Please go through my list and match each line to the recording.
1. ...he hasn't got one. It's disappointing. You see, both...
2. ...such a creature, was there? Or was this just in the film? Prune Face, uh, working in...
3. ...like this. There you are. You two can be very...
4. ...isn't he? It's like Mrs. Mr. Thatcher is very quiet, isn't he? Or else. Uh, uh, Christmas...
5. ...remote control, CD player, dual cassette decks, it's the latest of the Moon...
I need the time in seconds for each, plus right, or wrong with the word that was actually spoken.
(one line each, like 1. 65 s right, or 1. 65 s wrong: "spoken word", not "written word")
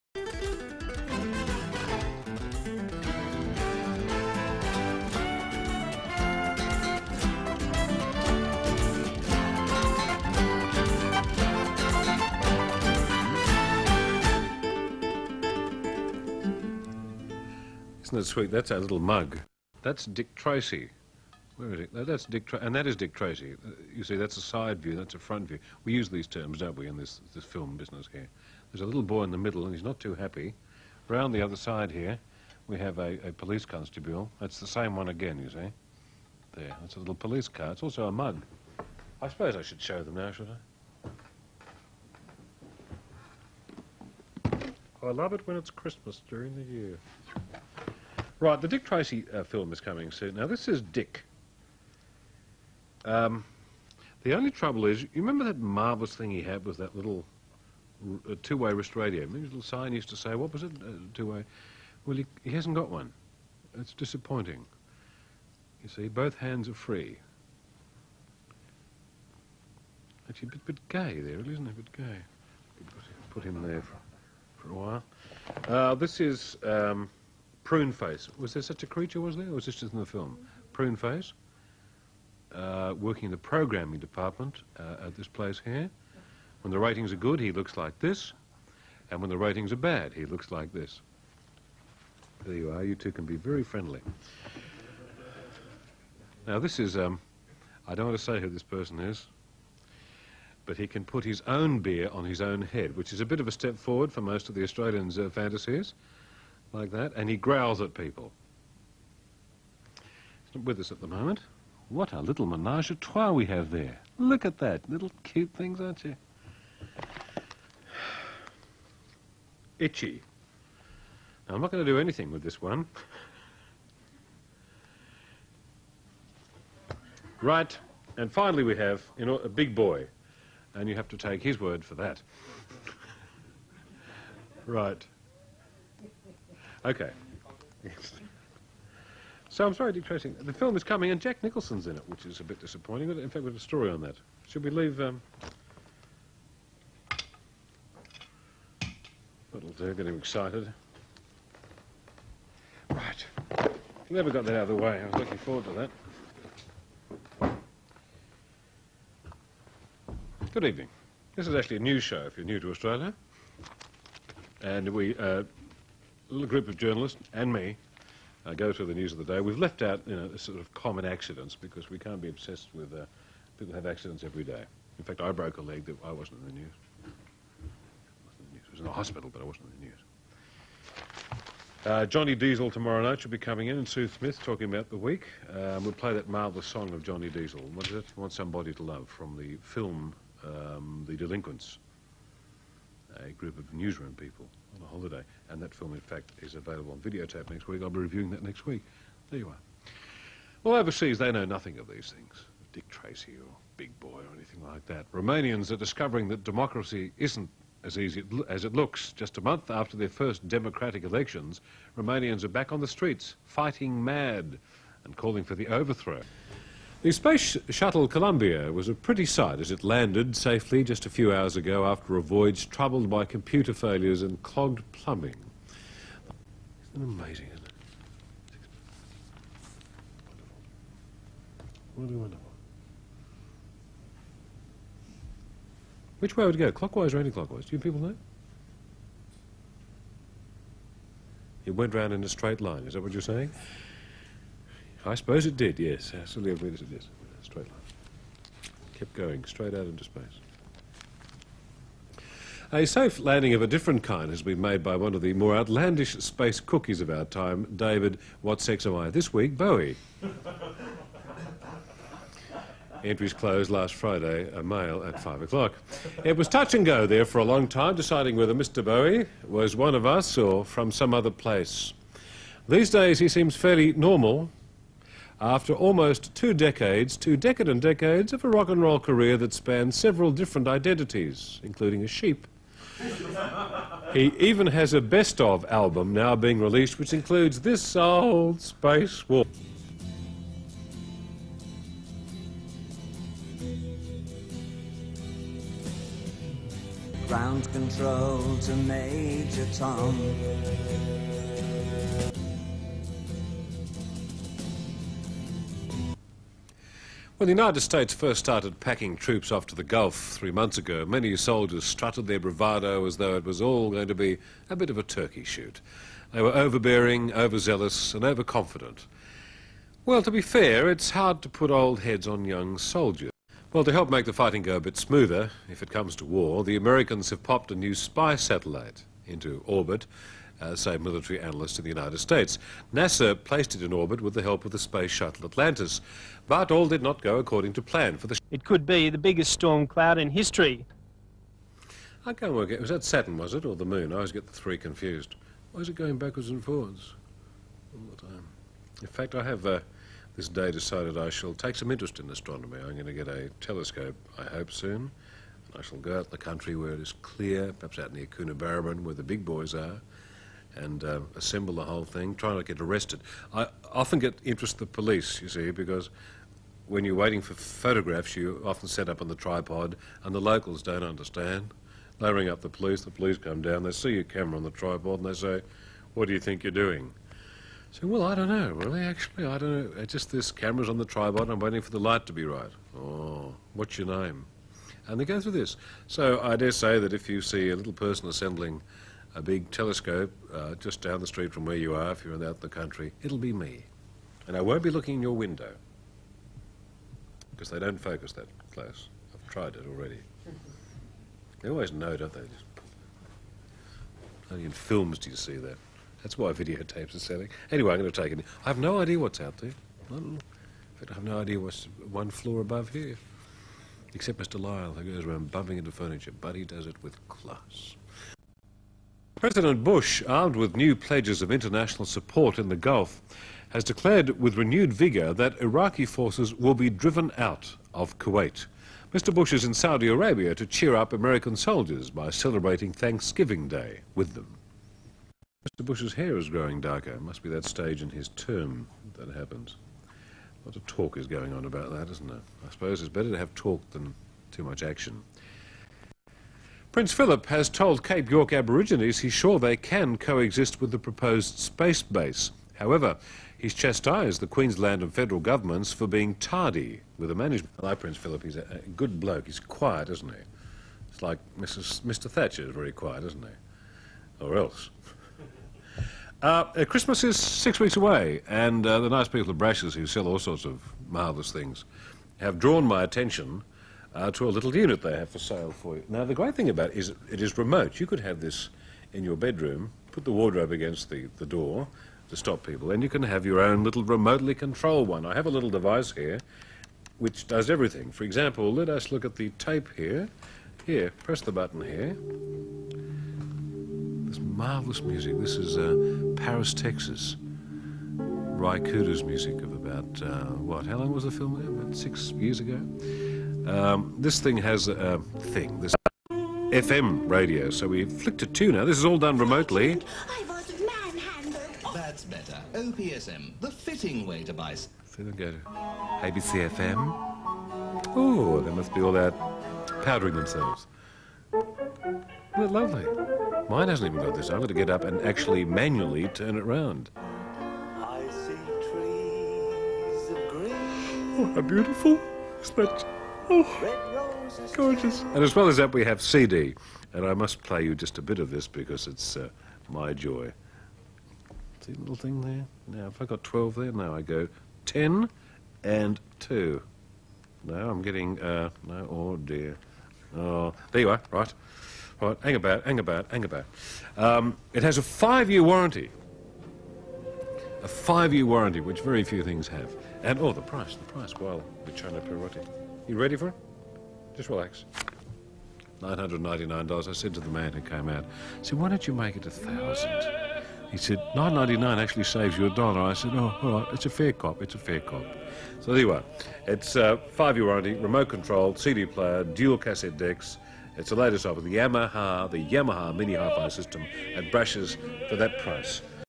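1. 62 s right
2. 78 s right
3. 90 s right
4. 460 s right
5. 577 s wrong: "Yamaha", not "Moon".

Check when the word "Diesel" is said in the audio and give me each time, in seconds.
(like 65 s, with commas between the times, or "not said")
182 s, 187 s.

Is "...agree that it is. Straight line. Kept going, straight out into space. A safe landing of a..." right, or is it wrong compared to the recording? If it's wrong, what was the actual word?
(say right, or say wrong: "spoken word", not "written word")
right.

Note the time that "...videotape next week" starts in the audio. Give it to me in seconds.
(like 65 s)
196 s.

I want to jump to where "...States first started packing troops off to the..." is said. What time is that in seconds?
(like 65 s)
307 s.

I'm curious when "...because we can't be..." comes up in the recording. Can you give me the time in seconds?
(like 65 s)
171 s.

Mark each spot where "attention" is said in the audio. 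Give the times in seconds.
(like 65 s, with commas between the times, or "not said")
473 s.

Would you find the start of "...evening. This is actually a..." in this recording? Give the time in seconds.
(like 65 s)
160 s.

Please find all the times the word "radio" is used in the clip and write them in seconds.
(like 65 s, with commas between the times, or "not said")
58 s, 507 s.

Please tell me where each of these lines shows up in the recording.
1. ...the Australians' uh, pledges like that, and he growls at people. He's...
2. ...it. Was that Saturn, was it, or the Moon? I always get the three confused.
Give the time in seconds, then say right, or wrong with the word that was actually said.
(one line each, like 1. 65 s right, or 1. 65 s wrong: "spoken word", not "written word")
1. 104 s wrong: "fantasies", not "pledges"
2. 342 s right.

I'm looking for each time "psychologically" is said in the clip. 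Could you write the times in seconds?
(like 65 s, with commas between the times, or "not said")
not said.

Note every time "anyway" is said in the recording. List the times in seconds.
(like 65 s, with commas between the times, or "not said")
407 s, 575 s.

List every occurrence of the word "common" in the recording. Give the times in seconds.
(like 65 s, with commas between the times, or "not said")
170 s.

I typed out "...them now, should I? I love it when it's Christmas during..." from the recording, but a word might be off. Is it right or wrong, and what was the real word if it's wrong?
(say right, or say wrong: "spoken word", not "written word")
right.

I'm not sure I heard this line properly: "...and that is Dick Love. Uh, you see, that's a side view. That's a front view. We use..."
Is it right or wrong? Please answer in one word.
wrong.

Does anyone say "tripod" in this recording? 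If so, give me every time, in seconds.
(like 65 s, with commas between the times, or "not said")
369 s, 374 s, 381 s.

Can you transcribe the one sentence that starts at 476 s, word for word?
Now, the great thing about it is it is remote.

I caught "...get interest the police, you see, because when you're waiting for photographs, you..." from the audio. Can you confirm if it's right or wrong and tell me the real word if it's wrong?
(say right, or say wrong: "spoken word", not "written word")
right.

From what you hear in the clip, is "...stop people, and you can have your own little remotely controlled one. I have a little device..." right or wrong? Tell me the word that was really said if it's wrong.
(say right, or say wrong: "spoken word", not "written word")
right.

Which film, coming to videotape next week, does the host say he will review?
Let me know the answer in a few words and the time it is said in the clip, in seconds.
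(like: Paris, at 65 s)
The Delinquents, at 191 s.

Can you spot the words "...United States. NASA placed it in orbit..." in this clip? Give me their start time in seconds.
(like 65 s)
331 s.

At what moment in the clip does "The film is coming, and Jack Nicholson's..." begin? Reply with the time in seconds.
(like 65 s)
140 s.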